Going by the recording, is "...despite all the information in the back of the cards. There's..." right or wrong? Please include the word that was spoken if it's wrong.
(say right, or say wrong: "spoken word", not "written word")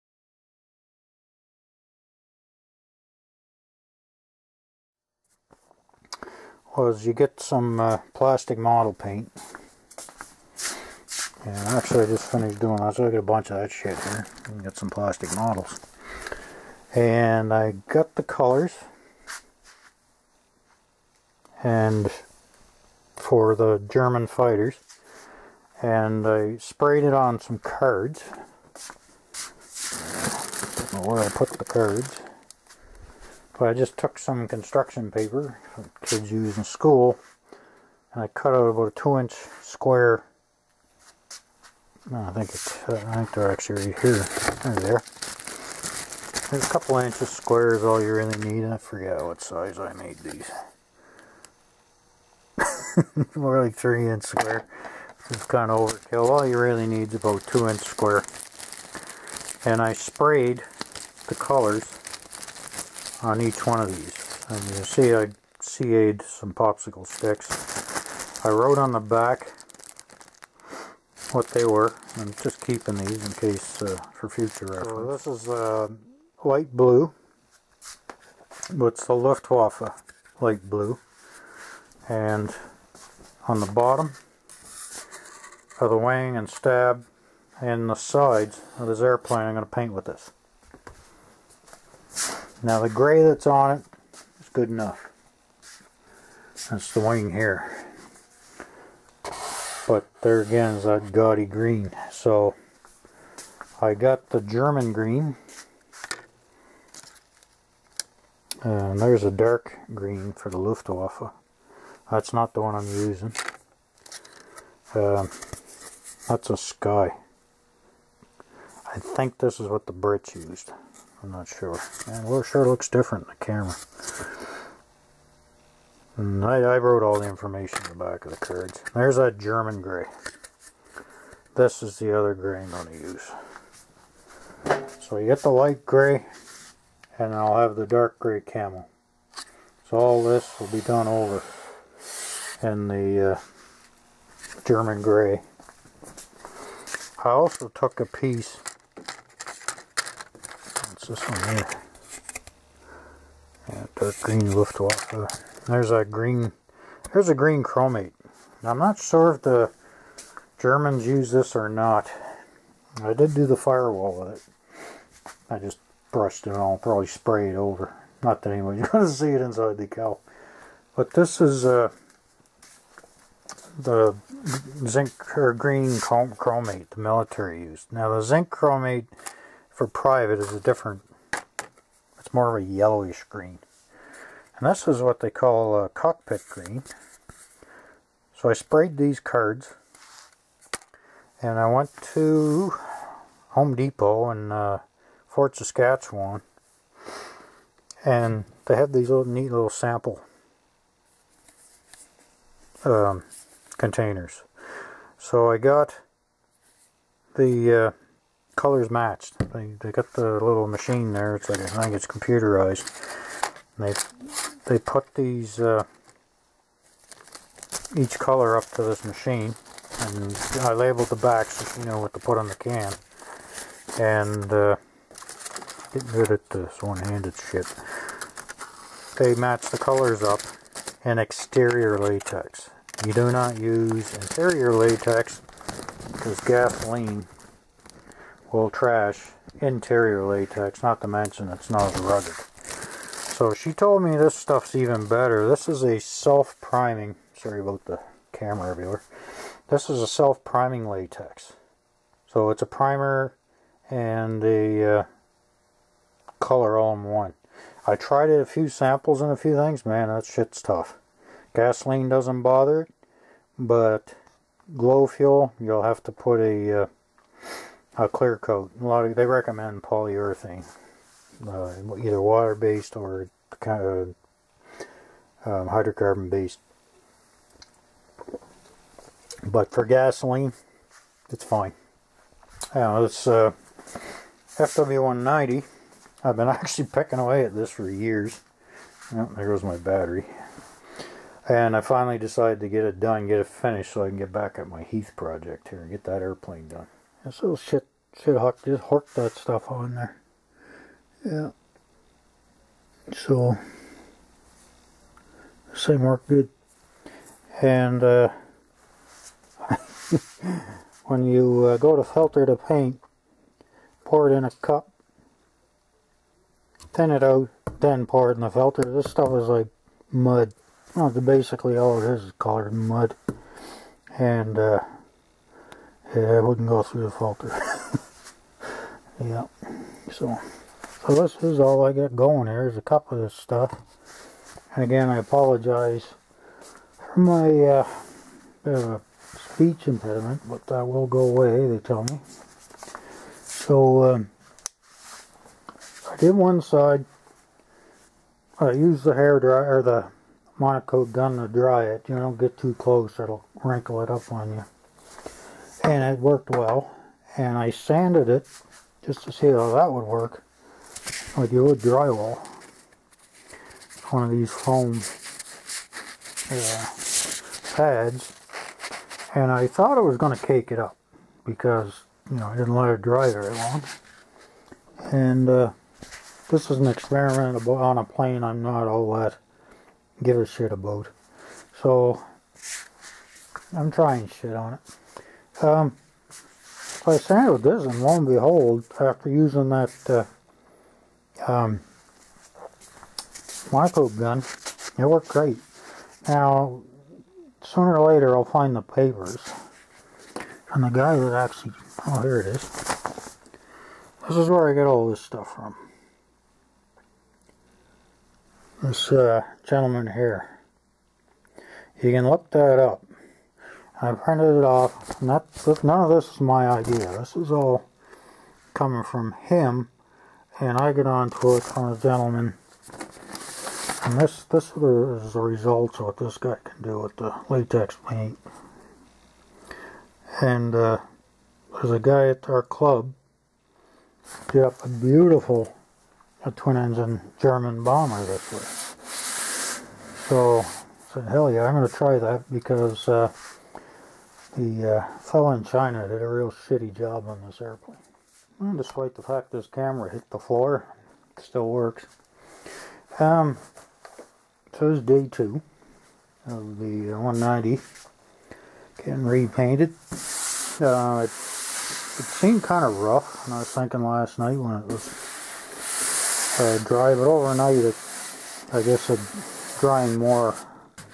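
wrong: "wrote", not "despite".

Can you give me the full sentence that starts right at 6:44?
This is where I get all this stuff from.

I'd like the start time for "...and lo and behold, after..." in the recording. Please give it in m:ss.
6:27.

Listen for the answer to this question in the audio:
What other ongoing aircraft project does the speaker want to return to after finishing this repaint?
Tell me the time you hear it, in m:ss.
4:54.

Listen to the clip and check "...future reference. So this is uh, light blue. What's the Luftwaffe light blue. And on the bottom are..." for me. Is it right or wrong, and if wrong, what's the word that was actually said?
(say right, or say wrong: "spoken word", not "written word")
right.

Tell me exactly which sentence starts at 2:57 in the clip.
Now the zinc chromate for private is a different, it's more of a yellowish green.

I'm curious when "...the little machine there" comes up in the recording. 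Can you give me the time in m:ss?
3:30.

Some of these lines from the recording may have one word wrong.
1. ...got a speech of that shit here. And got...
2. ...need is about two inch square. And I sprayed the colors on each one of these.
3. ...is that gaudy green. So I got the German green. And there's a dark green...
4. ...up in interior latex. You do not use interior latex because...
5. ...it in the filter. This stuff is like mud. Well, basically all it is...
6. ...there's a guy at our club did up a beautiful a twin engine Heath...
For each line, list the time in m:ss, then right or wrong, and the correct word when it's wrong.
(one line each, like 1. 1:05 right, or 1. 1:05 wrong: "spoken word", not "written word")
1. 0:13 wrong: "bunch", not "speech"
2. 0:56 right
3. 1:40 right
4. 3:50 wrong: "exterior", not "interior"
5. 5:18 right
6. 7:11 wrong: "German", not "Heath".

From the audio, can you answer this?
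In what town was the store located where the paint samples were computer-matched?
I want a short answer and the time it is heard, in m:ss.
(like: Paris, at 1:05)
Fort Saskatchewan, at 3:15.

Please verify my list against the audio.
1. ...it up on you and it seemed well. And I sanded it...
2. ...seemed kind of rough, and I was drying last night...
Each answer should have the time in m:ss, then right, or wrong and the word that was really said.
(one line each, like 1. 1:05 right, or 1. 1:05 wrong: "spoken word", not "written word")
1. 5:54 wrong: "worked", not "seemed"
2. 7:42 wrong: "thinking", not "drying".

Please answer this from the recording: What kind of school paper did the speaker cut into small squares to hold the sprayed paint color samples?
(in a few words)
Construction paper.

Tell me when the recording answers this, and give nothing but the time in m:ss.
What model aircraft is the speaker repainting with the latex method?
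4:44.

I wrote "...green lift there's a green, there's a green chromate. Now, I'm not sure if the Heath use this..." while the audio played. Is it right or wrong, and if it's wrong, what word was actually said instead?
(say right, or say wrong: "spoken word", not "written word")
wrong: "Germans", not "Heath".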